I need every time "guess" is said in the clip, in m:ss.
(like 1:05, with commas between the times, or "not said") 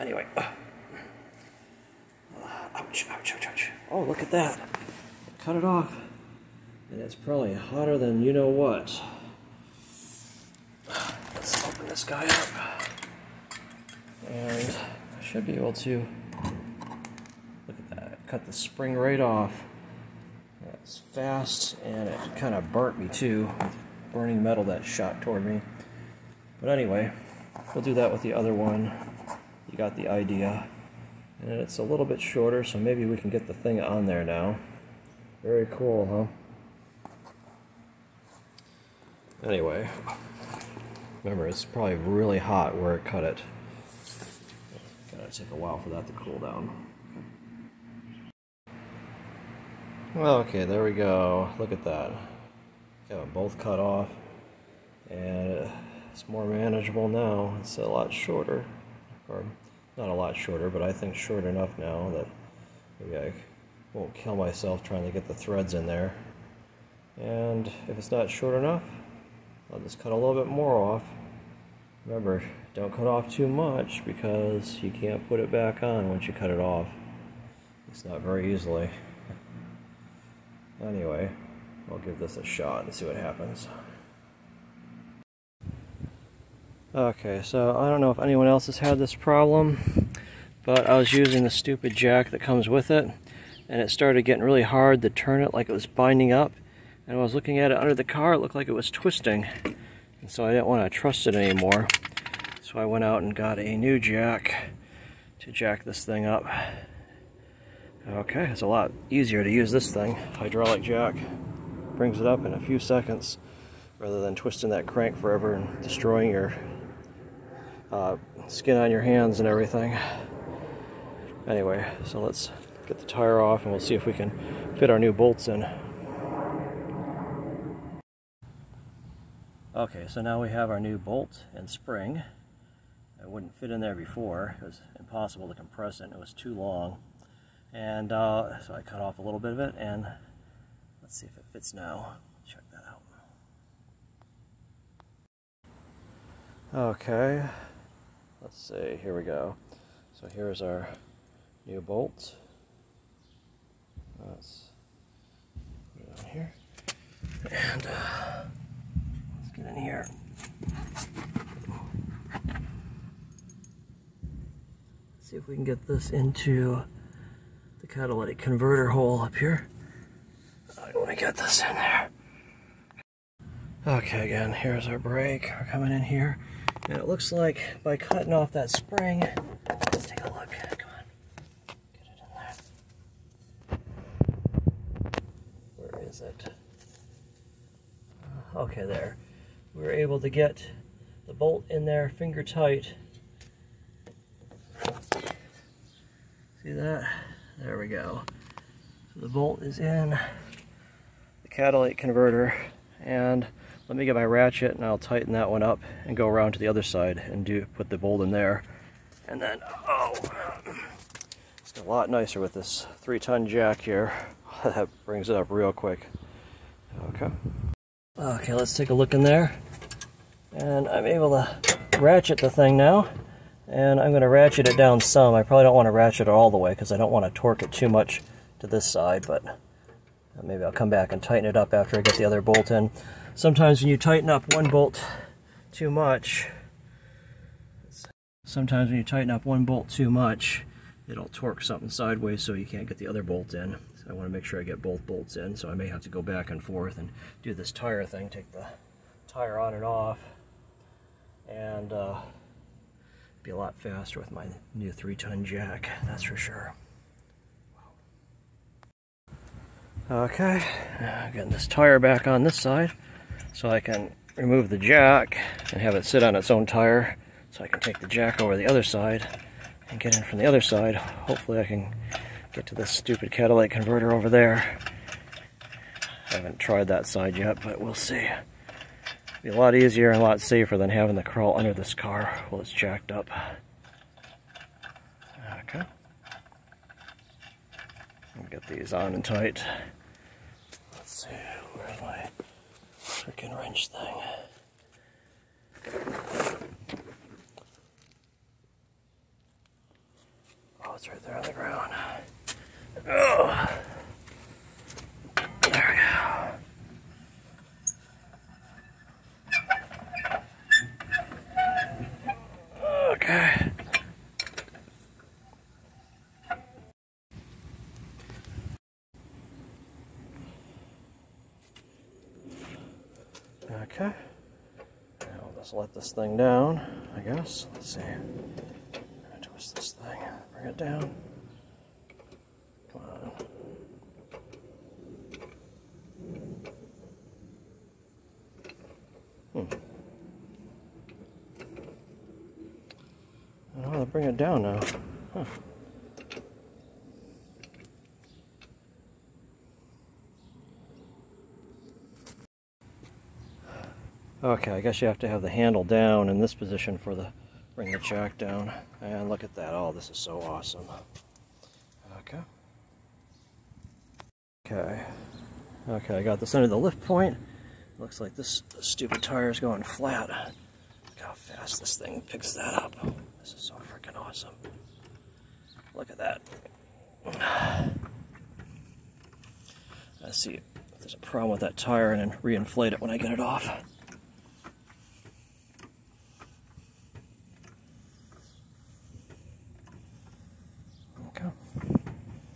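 5:27, 5:54.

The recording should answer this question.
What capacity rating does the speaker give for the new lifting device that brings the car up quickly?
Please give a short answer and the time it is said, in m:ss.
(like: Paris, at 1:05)
3 ton, at 3:33.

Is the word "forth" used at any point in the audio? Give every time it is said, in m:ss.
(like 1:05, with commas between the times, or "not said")
4:06.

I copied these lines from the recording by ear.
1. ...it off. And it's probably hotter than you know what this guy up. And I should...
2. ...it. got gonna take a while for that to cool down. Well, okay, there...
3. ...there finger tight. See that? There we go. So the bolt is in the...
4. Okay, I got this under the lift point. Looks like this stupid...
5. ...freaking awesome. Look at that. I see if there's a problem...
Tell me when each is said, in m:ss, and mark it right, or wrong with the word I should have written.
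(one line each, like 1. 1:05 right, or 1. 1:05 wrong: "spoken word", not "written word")
1. 0:05 right
2. 0:43 right
3. 3:11 right
4. 6:05 right
5. 6:13 right.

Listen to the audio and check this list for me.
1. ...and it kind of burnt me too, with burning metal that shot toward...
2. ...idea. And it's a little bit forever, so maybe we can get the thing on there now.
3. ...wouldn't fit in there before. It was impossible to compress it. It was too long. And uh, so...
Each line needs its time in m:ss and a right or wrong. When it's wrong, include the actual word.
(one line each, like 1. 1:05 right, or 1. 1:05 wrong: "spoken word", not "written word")
1. 0:21 right
2. 0:30 wrong: "shorter", not "forever"
3. 2:13 right.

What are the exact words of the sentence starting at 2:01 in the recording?
Anyway, so let's get the tire off and we'll see if we can fit our new bolts in.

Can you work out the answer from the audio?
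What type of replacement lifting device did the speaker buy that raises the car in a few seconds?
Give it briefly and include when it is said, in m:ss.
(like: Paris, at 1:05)
Hydraulic jack, at 1:50.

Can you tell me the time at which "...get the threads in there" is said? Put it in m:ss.
1:05.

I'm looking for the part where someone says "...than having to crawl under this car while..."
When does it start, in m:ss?
4:40.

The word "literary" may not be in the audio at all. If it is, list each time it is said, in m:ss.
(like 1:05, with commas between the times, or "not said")
not said.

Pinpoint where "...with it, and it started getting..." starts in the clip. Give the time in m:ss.
1:32.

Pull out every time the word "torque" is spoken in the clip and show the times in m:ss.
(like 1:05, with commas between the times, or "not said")
3:47, 4:01.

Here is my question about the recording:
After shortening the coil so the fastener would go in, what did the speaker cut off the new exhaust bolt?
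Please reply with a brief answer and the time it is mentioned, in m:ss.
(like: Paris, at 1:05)
The spring, at 0:18.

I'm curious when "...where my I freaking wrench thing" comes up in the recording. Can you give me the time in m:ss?
4:51.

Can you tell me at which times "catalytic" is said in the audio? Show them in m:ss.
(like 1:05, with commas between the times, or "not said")
2:47, 3:21, 4:33.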